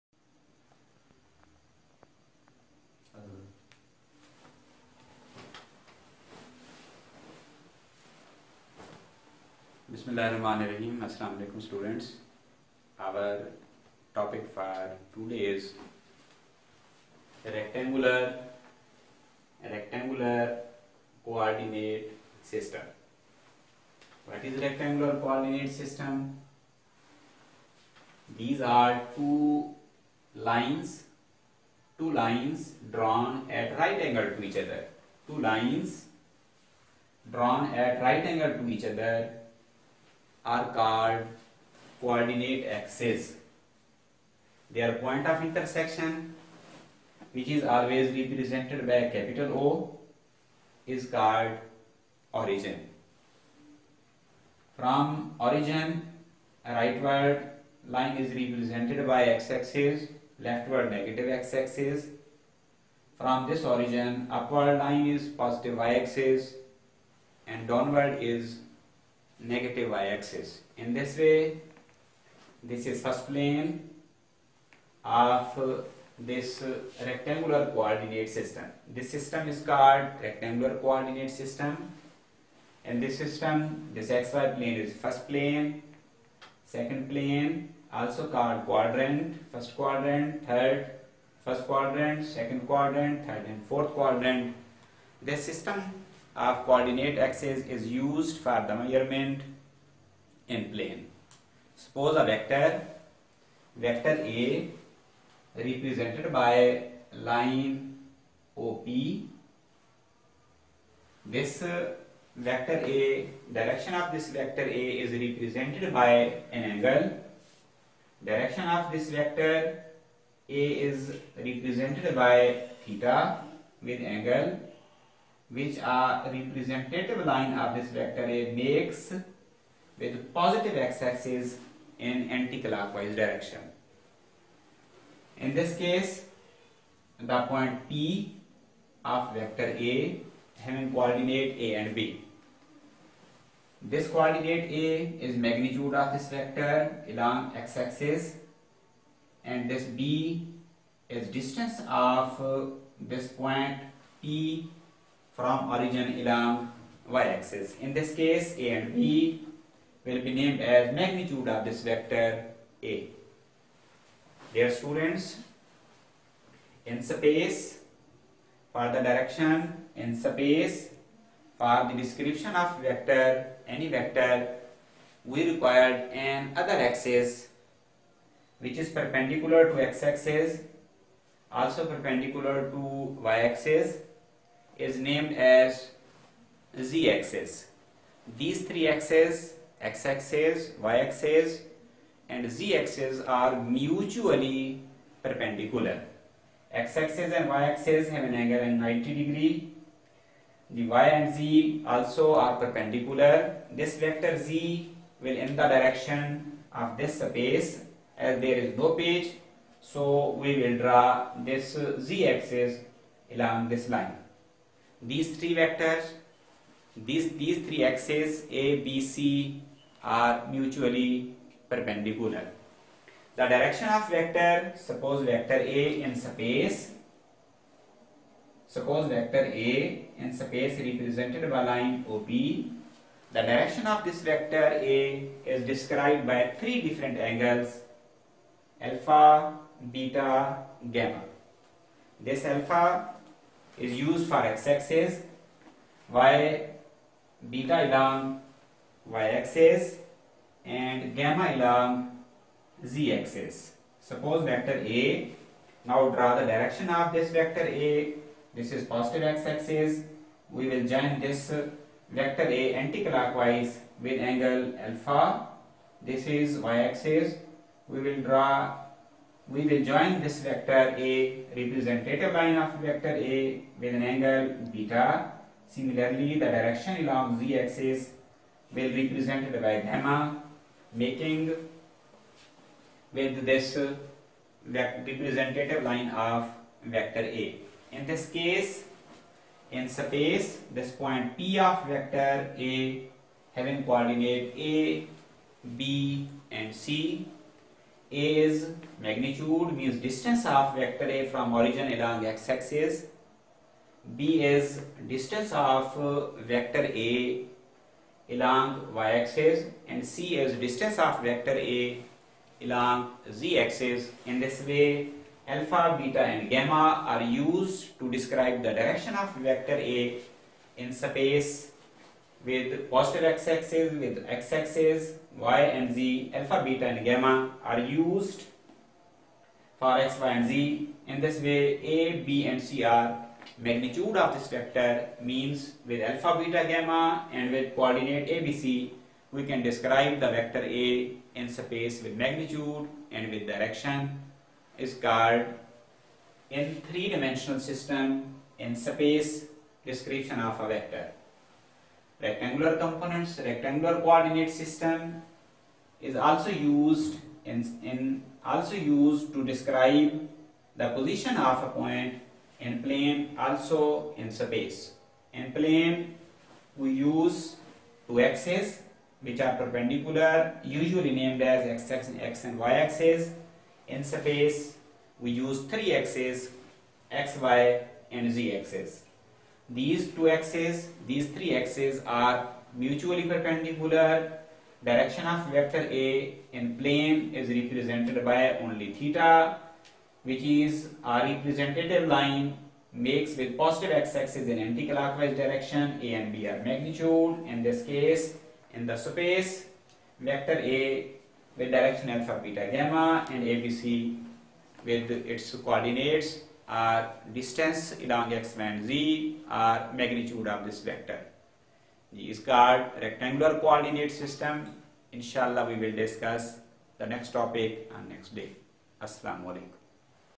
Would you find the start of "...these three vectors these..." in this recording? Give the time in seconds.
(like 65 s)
215 s.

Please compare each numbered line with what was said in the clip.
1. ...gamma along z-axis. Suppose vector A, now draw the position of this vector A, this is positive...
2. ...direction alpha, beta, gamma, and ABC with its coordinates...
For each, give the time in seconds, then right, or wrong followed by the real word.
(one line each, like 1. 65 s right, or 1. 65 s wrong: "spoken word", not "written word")
1. 251 s wrong: "direction", not "position"
2. 401 s right.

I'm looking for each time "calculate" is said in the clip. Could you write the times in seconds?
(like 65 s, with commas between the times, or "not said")
not said.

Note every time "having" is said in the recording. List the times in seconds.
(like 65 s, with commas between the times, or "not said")
140 s, 293 s.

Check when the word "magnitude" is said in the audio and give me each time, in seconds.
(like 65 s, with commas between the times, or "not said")
145 s, 160 s, 299 s, 333 s, 342 s, 396 s, 409 s.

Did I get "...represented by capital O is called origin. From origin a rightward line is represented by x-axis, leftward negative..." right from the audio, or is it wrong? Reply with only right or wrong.
right.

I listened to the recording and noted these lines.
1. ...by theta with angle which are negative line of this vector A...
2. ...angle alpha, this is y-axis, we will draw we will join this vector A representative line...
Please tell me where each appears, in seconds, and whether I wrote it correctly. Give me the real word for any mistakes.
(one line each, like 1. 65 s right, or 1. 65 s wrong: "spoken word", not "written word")
1. 122 s wrong: "representative", not "negative"
2. 264 s right.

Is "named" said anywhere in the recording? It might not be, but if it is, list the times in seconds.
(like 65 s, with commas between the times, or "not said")
160 s, 184 s, 371 s.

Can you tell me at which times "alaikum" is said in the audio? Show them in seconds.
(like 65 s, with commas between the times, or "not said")
11 s, 419 s.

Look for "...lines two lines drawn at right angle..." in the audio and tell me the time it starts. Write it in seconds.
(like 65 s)
30 s.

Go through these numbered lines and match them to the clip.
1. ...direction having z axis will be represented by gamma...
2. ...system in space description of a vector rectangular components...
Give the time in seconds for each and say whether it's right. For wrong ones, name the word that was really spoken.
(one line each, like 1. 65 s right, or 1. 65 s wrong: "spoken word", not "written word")
1. 276 s wrong: "along", not "having"
2. 347 s right.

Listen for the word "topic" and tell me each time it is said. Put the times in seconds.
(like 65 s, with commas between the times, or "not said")
14 s, 417 s.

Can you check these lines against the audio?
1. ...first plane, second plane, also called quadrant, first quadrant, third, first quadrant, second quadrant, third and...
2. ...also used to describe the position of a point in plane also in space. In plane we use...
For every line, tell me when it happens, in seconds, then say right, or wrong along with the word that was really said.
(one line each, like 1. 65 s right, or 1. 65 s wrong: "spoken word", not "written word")
1. 84 s right
2. 358 s right.